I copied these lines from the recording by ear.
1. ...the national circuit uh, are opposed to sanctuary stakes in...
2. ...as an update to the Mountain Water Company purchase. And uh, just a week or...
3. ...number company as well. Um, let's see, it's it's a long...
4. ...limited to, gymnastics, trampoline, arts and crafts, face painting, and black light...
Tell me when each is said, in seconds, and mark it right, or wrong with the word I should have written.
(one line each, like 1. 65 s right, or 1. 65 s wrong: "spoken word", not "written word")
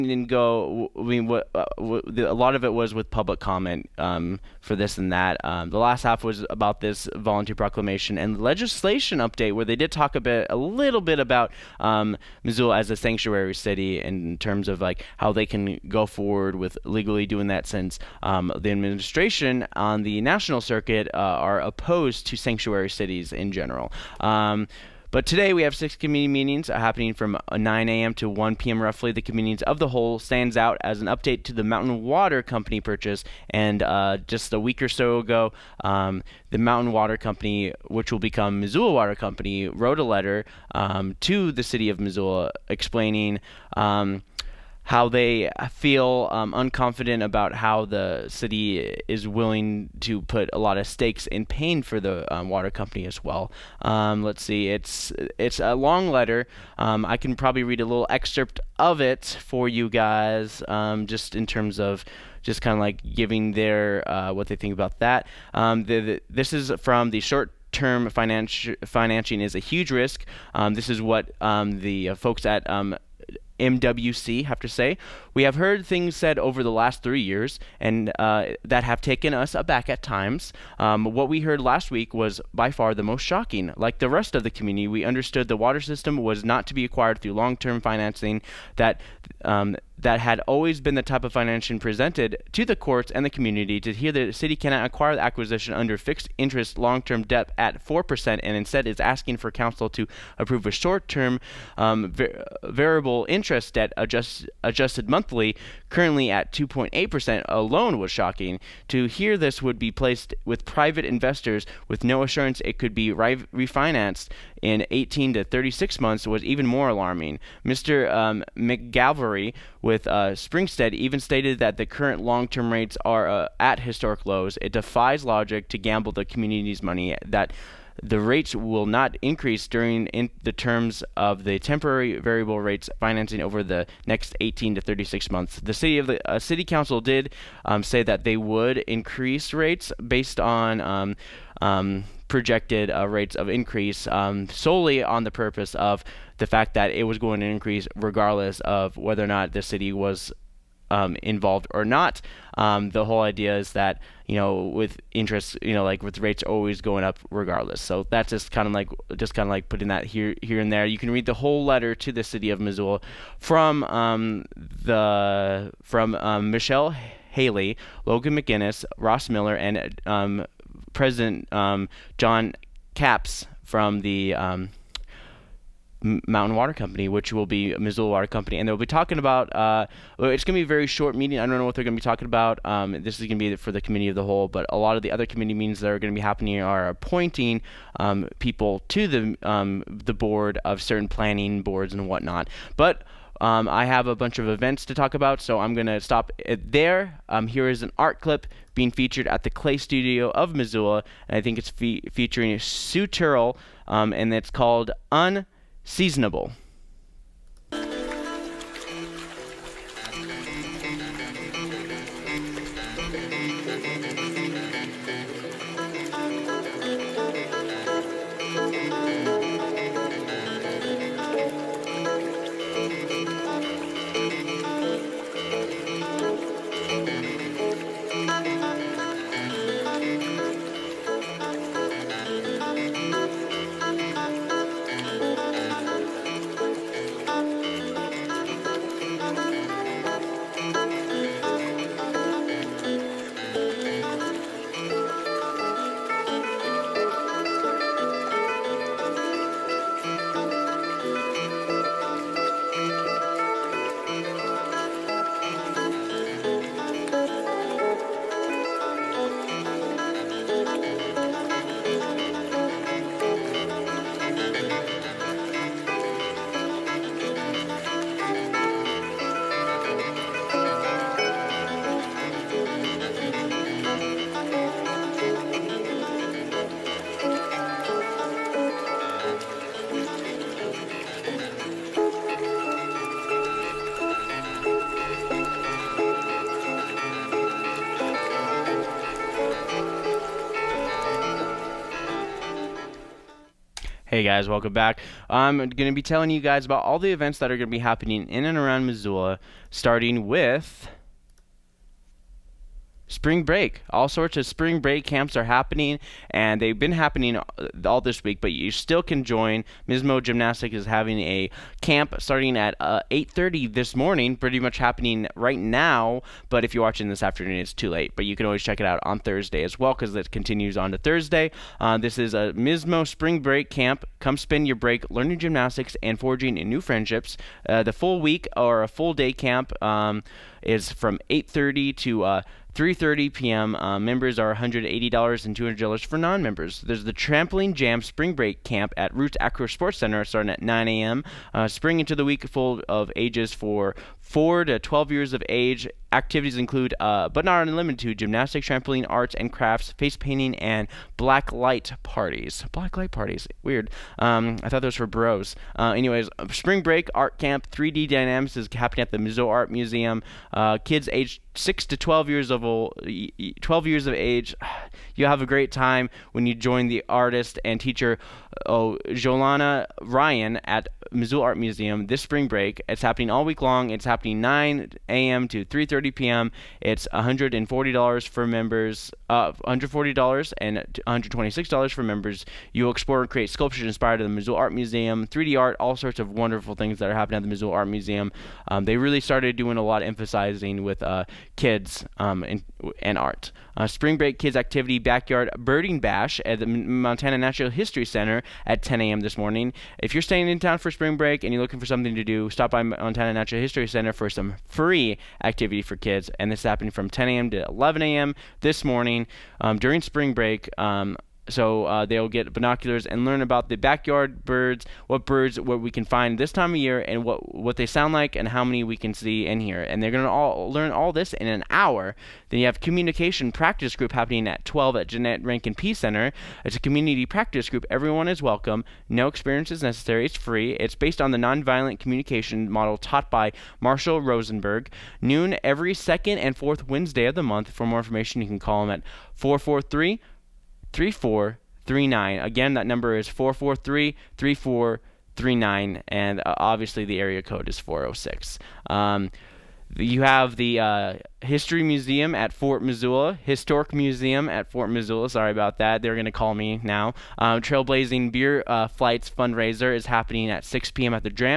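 1. 20 s wrong: "cities", not "stakes"
2. 30 s right
3. 52 s wrong: "water", not "number"
4. 347 s right.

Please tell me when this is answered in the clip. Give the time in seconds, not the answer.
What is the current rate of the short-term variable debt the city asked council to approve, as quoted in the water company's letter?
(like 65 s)
106 s.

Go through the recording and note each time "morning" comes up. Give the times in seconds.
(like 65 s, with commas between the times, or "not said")
313 s, 399 s, 408 s.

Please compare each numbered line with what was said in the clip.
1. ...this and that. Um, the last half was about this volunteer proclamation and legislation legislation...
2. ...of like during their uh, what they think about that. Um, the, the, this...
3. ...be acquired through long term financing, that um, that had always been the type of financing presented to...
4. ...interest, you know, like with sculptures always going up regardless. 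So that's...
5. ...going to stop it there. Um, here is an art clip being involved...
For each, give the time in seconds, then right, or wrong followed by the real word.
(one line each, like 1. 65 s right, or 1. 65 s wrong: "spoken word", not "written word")
1. 4 s right
2. 62 s wrong: "giving", not "during"
3. 86 s right
4. 155 s wrong: "rates", not "sculptures"
5. 195 s wrong: "featured", not "involved".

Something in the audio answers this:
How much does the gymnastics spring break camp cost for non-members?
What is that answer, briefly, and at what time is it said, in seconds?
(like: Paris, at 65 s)
$200, at 335 s.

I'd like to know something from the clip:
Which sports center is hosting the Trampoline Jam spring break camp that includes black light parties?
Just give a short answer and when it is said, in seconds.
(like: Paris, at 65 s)
Roots Acro Sports Center, at 339 s.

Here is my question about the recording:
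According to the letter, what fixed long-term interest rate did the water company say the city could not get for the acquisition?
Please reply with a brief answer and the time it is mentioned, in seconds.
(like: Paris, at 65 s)
4%, at 97 s.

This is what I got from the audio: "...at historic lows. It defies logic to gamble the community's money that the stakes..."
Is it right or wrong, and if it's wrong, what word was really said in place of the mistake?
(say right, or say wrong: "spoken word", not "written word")
wrong: "rates", not "stakes".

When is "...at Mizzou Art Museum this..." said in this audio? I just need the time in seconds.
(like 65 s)
370 s.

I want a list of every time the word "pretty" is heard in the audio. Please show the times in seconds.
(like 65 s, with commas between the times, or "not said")
314 s.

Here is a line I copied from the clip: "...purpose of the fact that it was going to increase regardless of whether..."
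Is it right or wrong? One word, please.
right.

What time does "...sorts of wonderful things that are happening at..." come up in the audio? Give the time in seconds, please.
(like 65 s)
385 s.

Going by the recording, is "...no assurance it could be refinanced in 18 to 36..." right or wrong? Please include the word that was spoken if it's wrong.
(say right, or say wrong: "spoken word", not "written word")
right.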